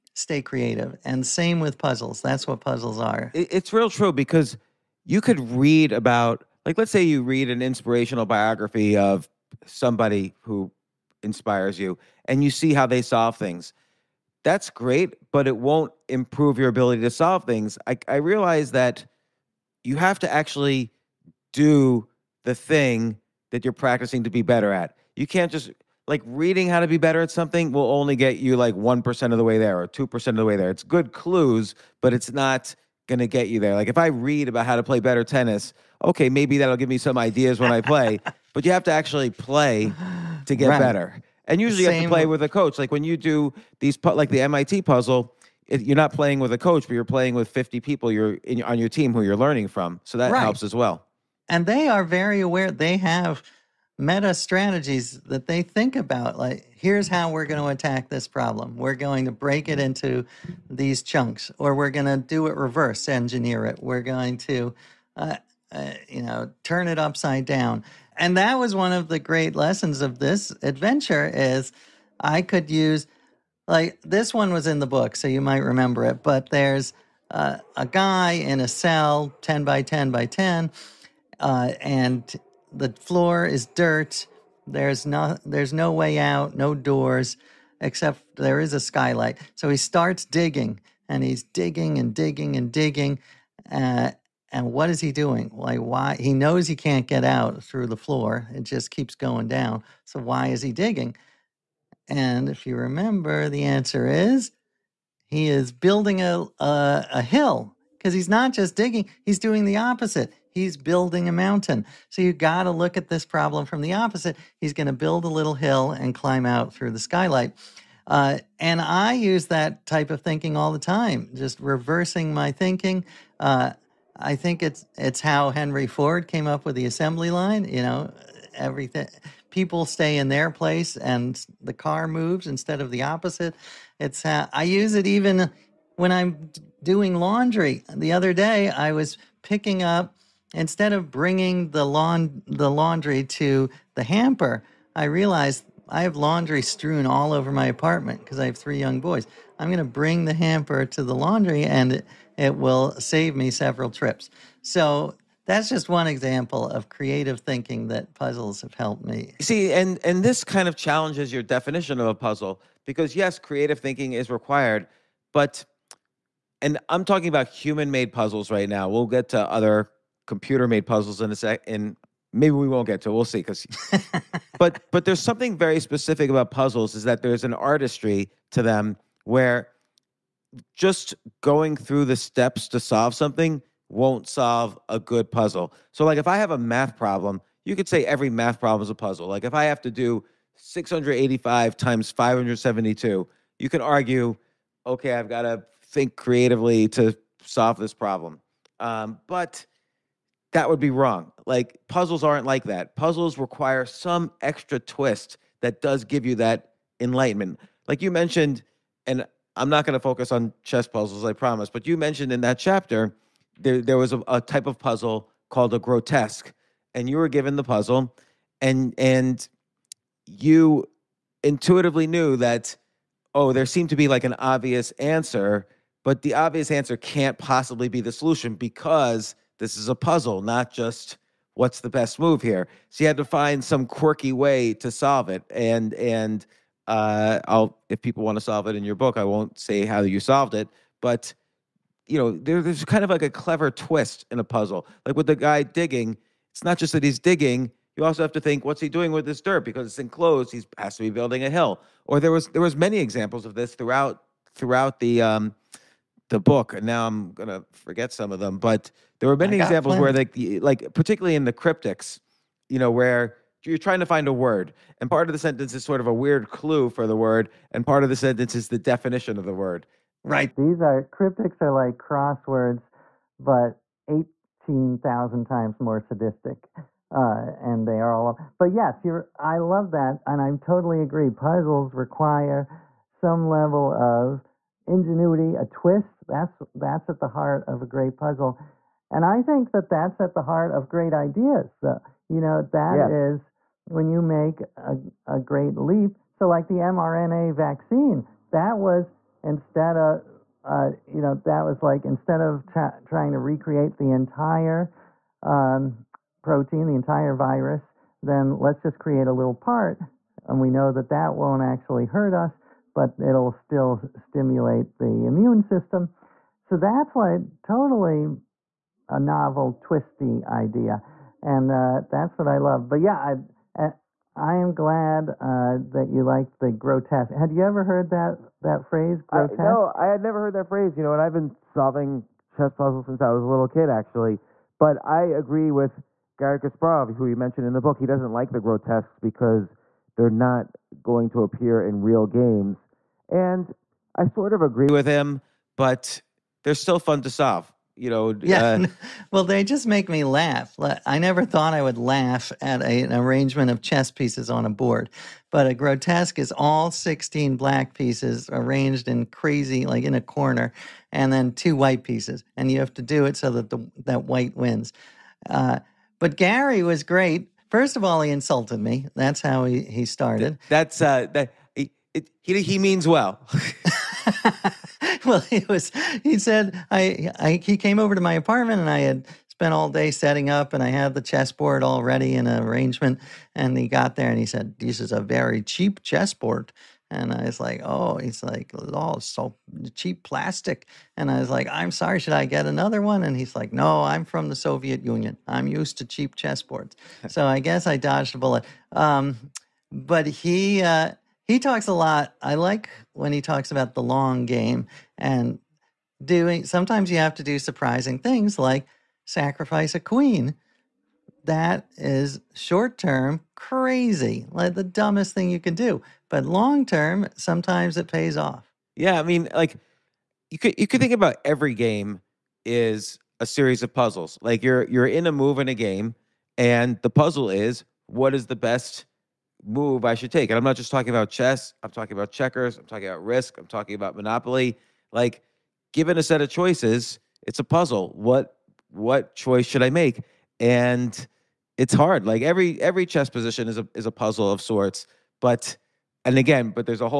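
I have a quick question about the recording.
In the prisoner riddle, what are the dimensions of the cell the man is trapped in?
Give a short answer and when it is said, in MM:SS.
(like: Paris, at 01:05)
10 by 10 by 10, at 01:19.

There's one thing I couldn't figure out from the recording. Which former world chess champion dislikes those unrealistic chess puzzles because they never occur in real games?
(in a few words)
Garry Kasparov.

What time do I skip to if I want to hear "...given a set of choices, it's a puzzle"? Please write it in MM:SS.
07:15.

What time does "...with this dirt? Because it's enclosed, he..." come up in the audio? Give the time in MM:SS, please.
04:09.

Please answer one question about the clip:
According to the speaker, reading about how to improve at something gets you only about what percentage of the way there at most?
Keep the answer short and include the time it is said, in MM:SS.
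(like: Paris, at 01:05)
2%, at 00:29.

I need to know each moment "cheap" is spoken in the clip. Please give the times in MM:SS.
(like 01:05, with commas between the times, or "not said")
06:25, 06:29, 06:36.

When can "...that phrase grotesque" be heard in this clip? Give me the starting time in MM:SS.
05:28.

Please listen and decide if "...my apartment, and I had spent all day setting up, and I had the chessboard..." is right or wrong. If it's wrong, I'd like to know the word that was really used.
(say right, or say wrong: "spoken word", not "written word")
right.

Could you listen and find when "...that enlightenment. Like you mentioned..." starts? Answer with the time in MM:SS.
03:26.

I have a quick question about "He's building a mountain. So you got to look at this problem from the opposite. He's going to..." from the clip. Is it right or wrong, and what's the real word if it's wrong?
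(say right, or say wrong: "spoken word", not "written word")
right.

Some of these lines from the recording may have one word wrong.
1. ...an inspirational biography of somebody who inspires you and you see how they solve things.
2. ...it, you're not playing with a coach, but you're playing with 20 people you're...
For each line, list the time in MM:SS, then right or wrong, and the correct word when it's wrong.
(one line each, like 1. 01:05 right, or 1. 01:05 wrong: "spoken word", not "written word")
1. 00:07 right
2. 00:45 wrong: "50", not "20".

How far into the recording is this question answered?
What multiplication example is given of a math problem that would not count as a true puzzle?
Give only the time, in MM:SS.
03:10.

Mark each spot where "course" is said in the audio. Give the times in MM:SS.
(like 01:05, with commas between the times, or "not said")
not said.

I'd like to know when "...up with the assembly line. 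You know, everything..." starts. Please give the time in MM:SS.
02:06.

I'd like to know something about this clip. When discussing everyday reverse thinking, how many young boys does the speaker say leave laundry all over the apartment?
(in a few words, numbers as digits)
3.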